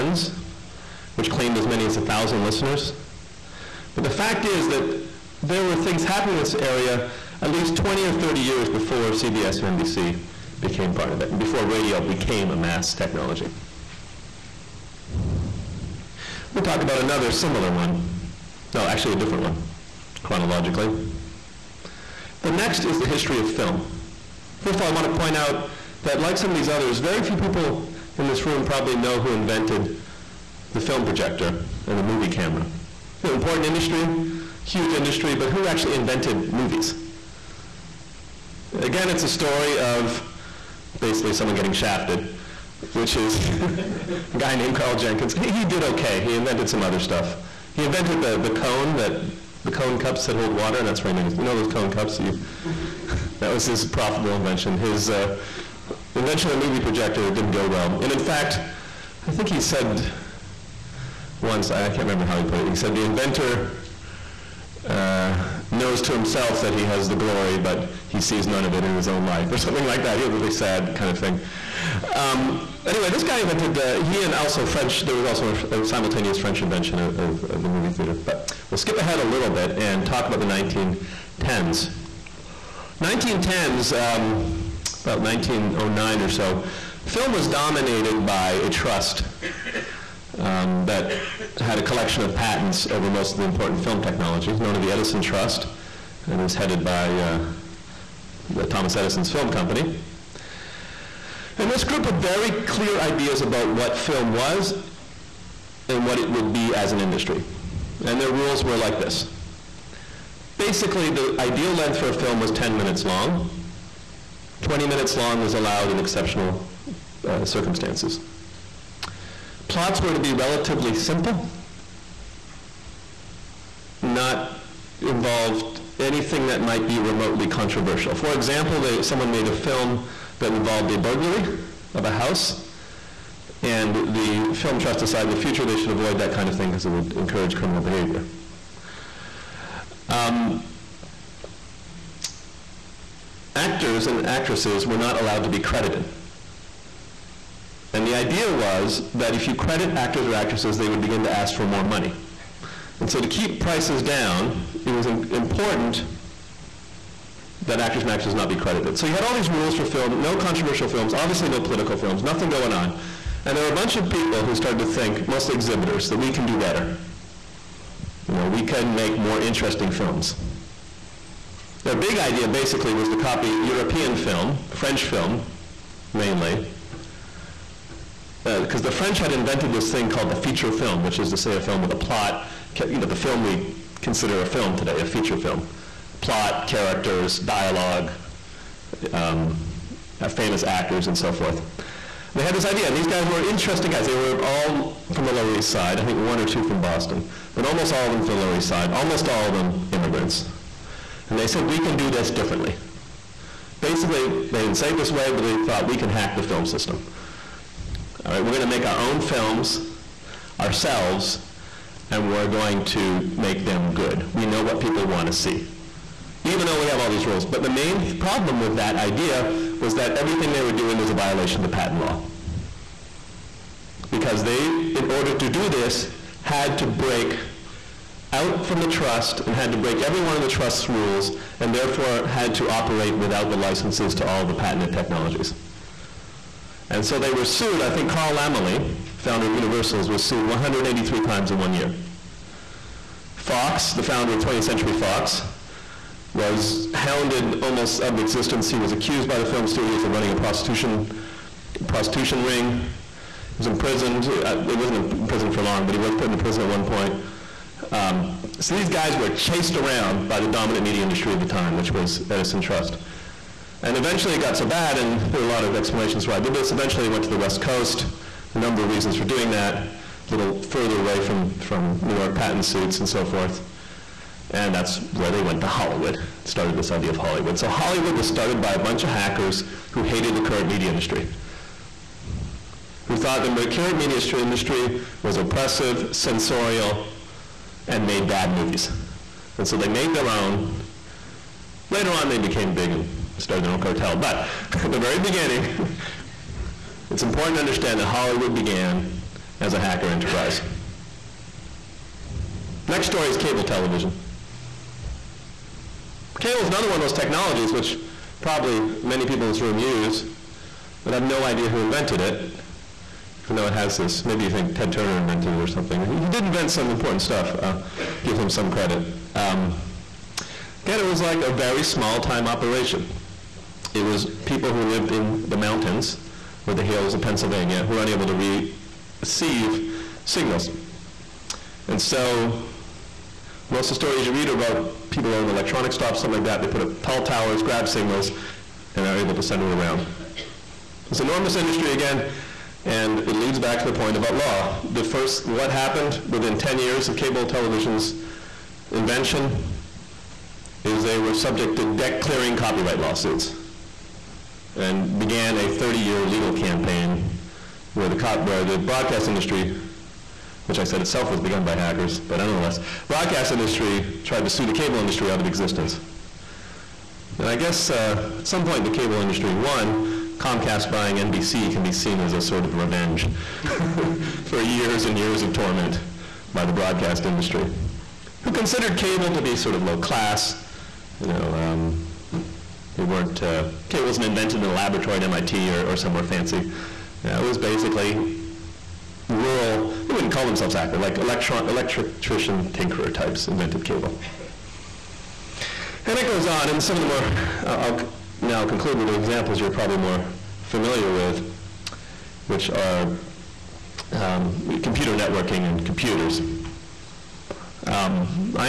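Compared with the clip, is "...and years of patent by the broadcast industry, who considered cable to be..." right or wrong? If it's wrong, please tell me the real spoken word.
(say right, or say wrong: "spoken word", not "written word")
wrong: "torment", not "patent".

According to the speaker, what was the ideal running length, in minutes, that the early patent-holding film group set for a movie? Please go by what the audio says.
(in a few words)
10.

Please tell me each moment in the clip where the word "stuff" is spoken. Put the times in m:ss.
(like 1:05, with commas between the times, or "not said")
0:46, 5:17.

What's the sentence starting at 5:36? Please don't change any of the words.
They put up tall towers, grab signals, and they are able to send it around.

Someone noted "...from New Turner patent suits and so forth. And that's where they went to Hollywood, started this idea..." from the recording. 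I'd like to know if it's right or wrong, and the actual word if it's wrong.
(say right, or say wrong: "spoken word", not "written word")
wrong: "York", not "Turner".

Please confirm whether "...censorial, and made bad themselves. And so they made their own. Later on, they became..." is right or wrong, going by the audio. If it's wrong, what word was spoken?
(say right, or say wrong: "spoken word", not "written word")
wrong: "movies", not "themselves".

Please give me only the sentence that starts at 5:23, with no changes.
It was people who lived in the mountains or the hills of Pennsylvania who are unable to re receive signals.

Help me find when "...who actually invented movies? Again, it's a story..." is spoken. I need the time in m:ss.
0:35.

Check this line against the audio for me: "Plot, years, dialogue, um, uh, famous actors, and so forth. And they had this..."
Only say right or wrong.
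wrong.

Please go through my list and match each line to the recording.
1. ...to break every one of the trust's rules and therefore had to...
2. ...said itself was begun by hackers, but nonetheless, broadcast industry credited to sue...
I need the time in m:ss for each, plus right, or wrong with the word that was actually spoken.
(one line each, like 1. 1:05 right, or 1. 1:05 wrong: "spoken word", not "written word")
1. 3:49 right
2. 6:00 wrong: "tried", not "credited".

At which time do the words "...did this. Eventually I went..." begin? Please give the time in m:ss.
4:26.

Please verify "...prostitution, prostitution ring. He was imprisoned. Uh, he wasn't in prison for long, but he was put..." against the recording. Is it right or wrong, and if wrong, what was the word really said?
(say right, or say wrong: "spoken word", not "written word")
right.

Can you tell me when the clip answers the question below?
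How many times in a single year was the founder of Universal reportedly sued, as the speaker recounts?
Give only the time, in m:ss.
4:00.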